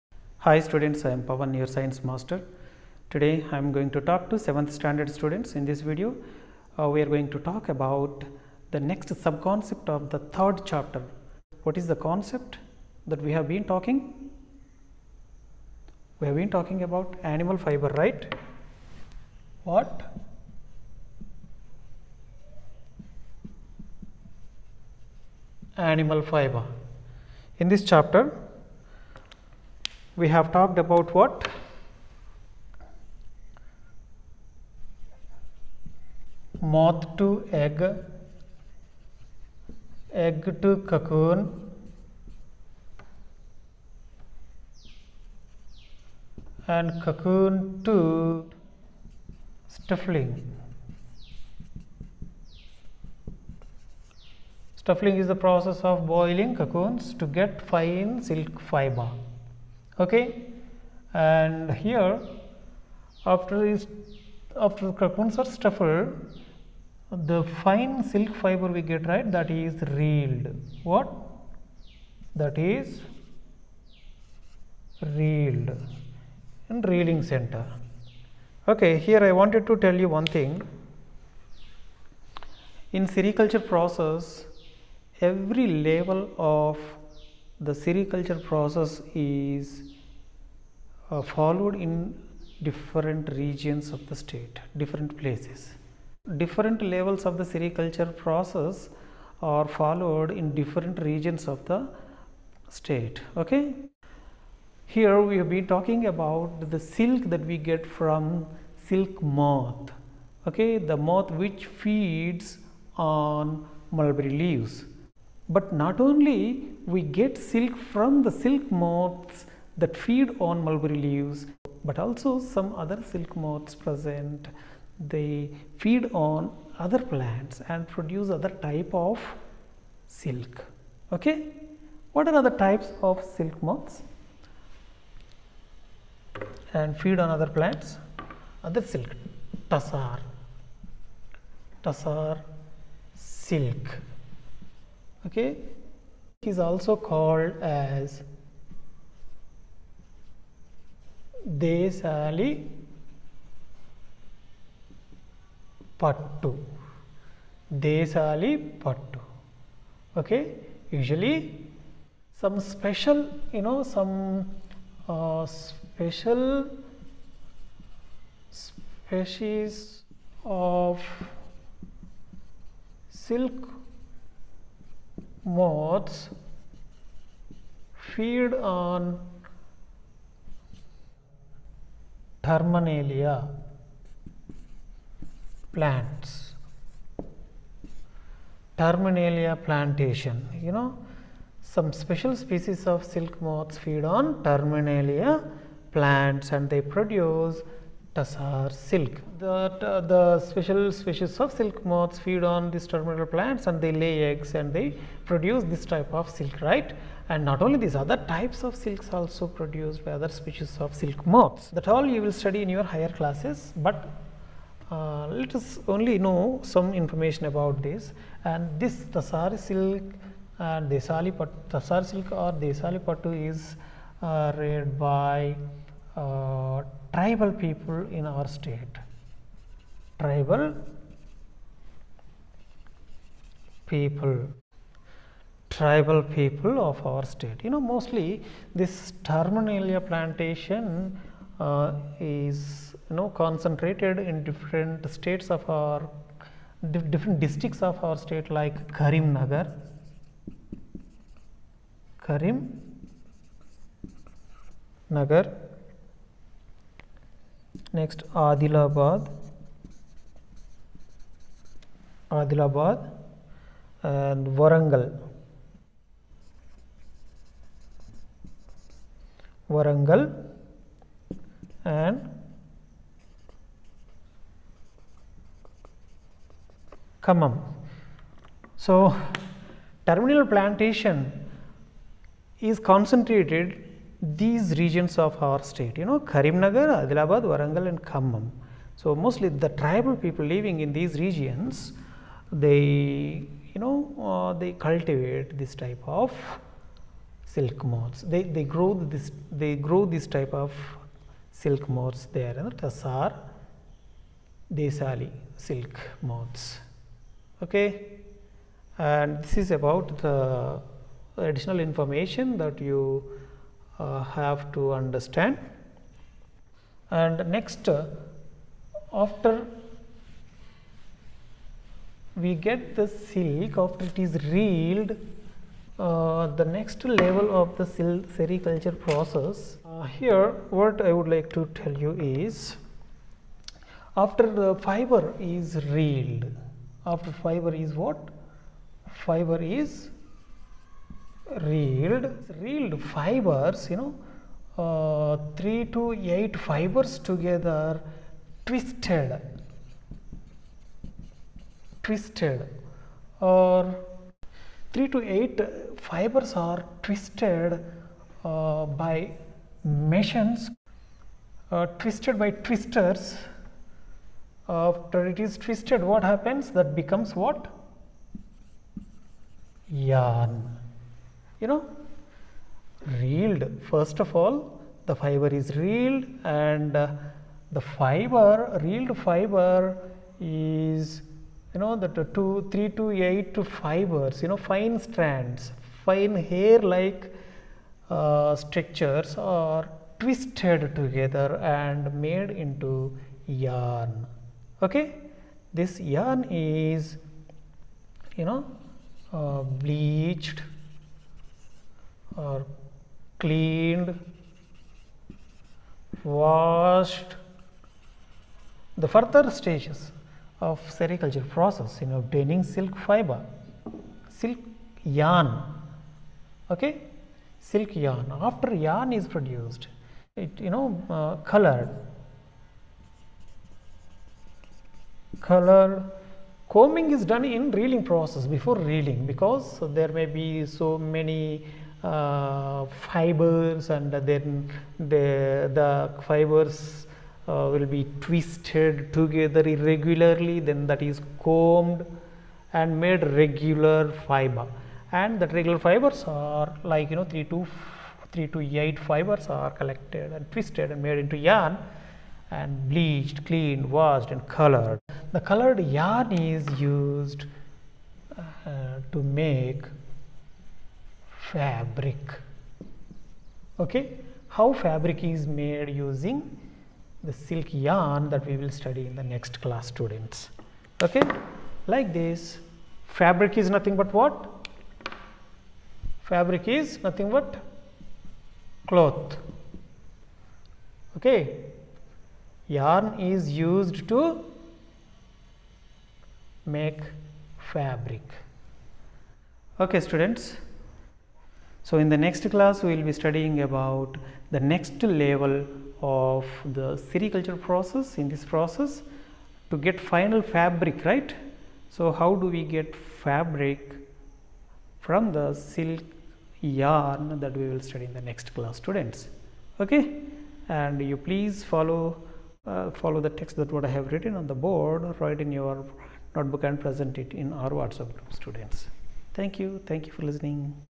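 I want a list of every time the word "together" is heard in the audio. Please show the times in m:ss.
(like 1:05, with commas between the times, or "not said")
5:47, 6:30, 7:19.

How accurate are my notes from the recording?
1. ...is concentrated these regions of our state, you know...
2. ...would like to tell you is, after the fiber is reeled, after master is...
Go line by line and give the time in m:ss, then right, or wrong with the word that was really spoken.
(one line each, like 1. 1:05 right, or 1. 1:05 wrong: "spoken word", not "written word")
1. 4:42 right
2. 5:31 wrong: "fiber", not "master".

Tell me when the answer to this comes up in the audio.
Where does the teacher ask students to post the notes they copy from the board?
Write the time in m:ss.
8:37.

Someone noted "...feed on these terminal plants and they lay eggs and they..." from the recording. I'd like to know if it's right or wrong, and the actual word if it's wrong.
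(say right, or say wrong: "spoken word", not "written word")
right.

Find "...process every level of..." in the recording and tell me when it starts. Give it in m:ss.
1:23.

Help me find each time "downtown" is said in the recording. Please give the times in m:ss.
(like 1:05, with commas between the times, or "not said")
not said.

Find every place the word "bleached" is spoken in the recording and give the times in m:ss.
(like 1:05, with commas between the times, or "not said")
6:39, 7:32.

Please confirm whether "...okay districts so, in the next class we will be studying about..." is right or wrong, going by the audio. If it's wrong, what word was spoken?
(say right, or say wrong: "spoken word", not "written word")
wrong: "students", not "districts".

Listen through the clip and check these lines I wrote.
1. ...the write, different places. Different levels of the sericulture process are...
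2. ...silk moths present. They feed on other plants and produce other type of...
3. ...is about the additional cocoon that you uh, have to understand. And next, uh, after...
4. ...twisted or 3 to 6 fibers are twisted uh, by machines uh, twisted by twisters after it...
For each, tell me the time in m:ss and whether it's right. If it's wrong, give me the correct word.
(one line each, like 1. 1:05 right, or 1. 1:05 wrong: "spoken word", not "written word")
1. 1:34 wrong: "state", not "write"
2. 2:03 right
3. 5:09 wrong: "information", not "cocoon"
4. 5:52 wrong: "8", not "6".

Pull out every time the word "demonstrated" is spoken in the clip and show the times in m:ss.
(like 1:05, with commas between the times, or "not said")
not said.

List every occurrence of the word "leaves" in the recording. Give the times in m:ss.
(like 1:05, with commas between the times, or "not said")
1:54, 2:01.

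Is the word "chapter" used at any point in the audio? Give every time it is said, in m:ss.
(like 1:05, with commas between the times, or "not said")
0:10, 0:27.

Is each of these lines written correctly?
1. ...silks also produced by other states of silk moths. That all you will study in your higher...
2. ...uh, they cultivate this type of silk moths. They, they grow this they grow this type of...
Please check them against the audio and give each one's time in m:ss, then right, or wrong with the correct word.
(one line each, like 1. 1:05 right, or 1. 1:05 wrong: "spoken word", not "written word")
1. 3:28 wrong: "species", not "states"
2. 4:54 right.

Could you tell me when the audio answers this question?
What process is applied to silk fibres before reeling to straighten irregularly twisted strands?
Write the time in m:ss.
7:06.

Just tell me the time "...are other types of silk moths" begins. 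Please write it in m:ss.
2:12.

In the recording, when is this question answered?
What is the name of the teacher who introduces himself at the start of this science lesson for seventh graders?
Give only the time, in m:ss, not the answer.
0:01.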